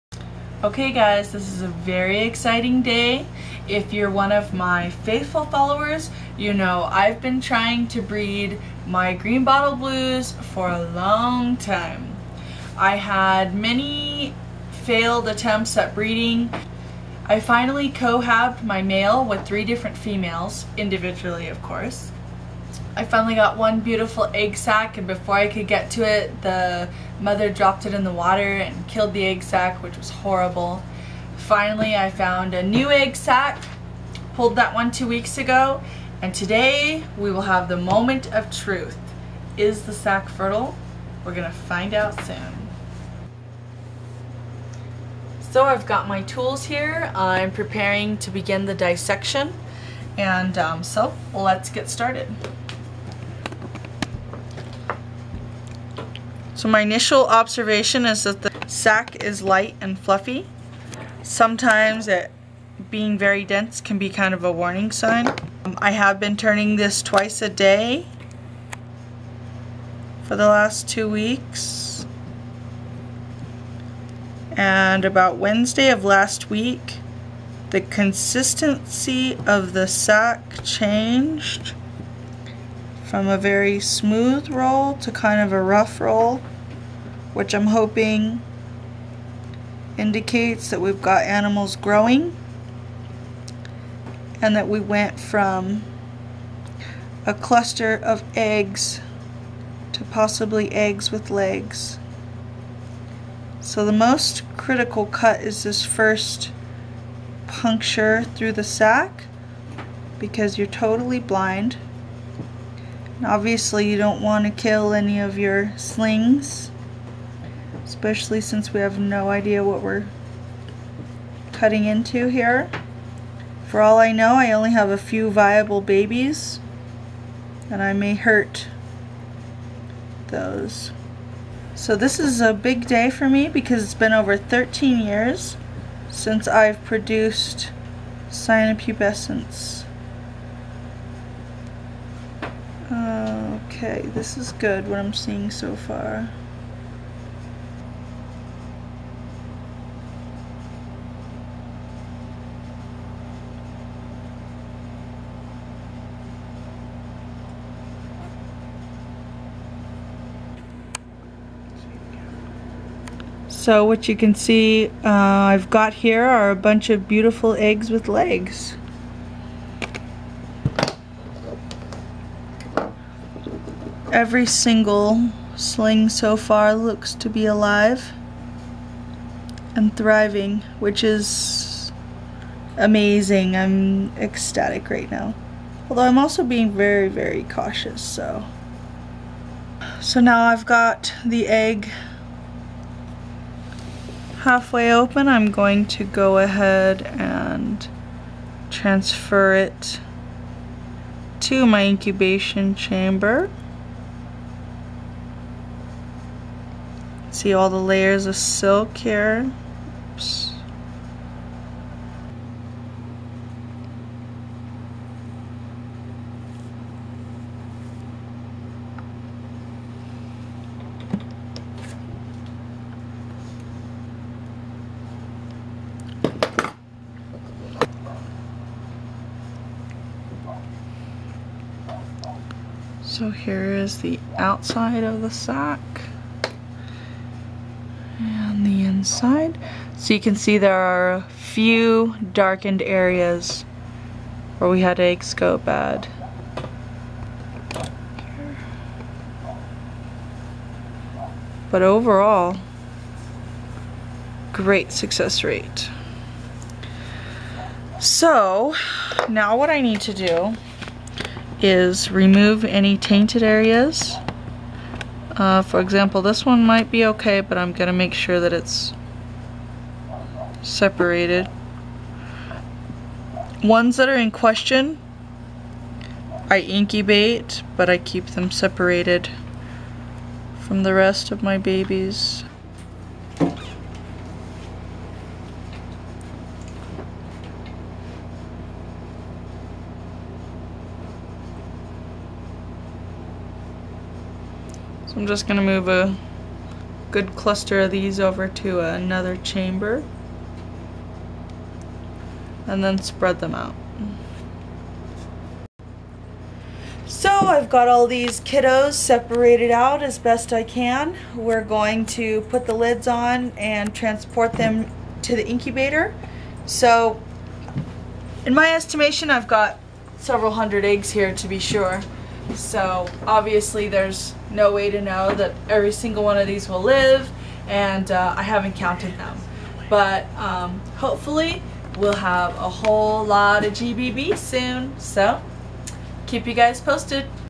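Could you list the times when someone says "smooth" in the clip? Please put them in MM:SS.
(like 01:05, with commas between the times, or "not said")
01:23.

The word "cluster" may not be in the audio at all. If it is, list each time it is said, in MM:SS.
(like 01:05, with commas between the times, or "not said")
01:37, 04:57.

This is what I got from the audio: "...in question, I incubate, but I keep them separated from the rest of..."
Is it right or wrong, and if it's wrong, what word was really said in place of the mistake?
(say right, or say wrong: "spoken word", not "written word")
right.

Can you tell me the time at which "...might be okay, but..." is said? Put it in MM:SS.
04:26.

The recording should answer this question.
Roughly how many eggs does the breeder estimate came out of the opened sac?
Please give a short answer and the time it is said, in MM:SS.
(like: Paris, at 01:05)
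several hundred, at 05:20.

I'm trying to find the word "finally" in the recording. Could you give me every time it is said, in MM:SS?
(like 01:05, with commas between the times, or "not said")
00:17, 00:23, 00:31.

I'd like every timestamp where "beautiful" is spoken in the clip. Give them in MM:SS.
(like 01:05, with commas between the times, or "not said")
00:23, 02:47.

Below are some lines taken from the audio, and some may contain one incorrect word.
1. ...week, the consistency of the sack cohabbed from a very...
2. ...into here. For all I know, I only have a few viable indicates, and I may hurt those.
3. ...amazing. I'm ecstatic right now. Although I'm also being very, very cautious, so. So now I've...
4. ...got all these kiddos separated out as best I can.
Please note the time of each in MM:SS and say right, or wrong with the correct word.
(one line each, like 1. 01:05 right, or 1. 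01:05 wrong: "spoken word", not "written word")
1. 01:16 wrong: "changed", not "cohabbed"
2. 02:01 wrong: "babies", not "indicates"
3. 03:02 right
4. 05:07 right.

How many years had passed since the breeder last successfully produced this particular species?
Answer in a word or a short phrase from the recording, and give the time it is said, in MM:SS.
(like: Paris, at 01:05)
13, at 02:14.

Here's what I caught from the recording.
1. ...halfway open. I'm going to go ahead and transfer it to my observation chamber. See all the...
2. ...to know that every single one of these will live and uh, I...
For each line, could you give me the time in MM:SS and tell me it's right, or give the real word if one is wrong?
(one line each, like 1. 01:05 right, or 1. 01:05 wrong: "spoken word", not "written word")
1. 03:14 wrong: "incubation", not "observation"
2. 05:24 right.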